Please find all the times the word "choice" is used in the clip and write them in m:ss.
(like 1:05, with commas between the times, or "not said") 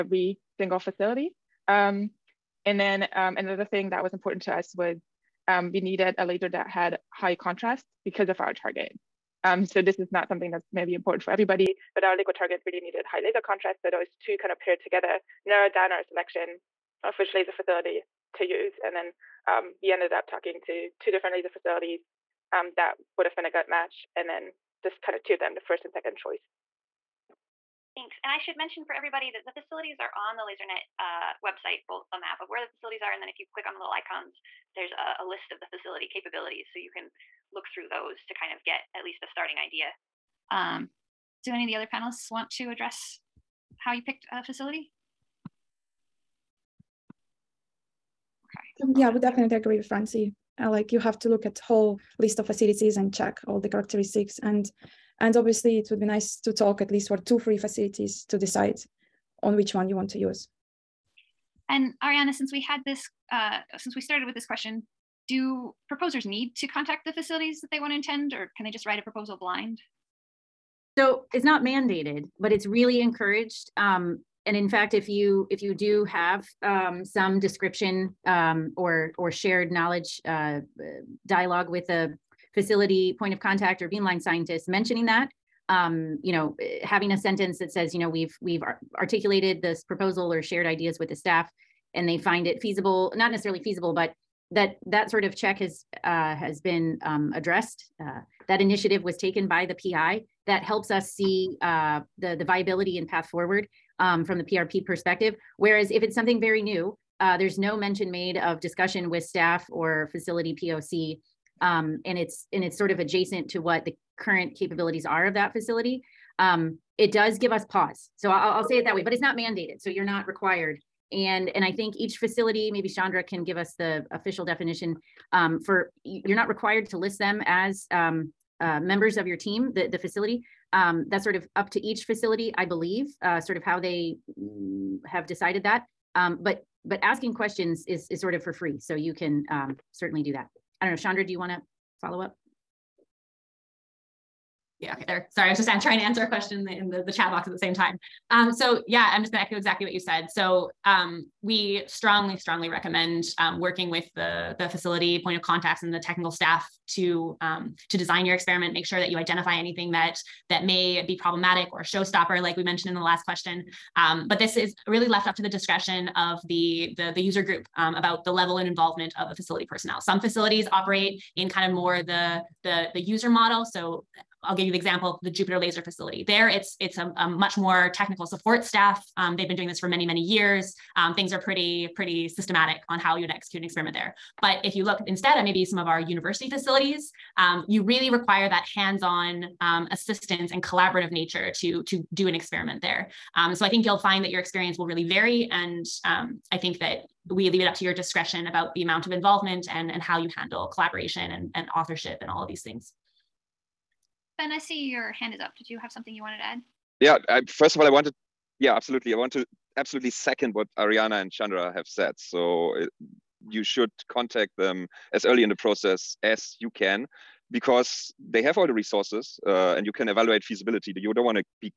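0:26.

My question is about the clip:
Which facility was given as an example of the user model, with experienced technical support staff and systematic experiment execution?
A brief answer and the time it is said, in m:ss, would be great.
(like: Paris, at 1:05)
Jupiter Laser Facility, at 2:55.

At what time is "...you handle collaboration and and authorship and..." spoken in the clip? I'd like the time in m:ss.
3:20.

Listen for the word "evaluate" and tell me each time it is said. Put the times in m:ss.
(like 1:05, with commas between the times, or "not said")
3:40.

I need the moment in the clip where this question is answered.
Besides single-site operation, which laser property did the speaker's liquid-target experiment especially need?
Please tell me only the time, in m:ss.
0:13.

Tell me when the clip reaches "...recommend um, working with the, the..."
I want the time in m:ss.
2:32.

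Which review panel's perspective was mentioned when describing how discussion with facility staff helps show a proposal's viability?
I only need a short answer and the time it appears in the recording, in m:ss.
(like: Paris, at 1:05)
PRP, at 1:44.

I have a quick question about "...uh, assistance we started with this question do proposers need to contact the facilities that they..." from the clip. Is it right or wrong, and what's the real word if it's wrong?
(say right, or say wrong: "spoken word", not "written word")
wrong: "since", not "assistance".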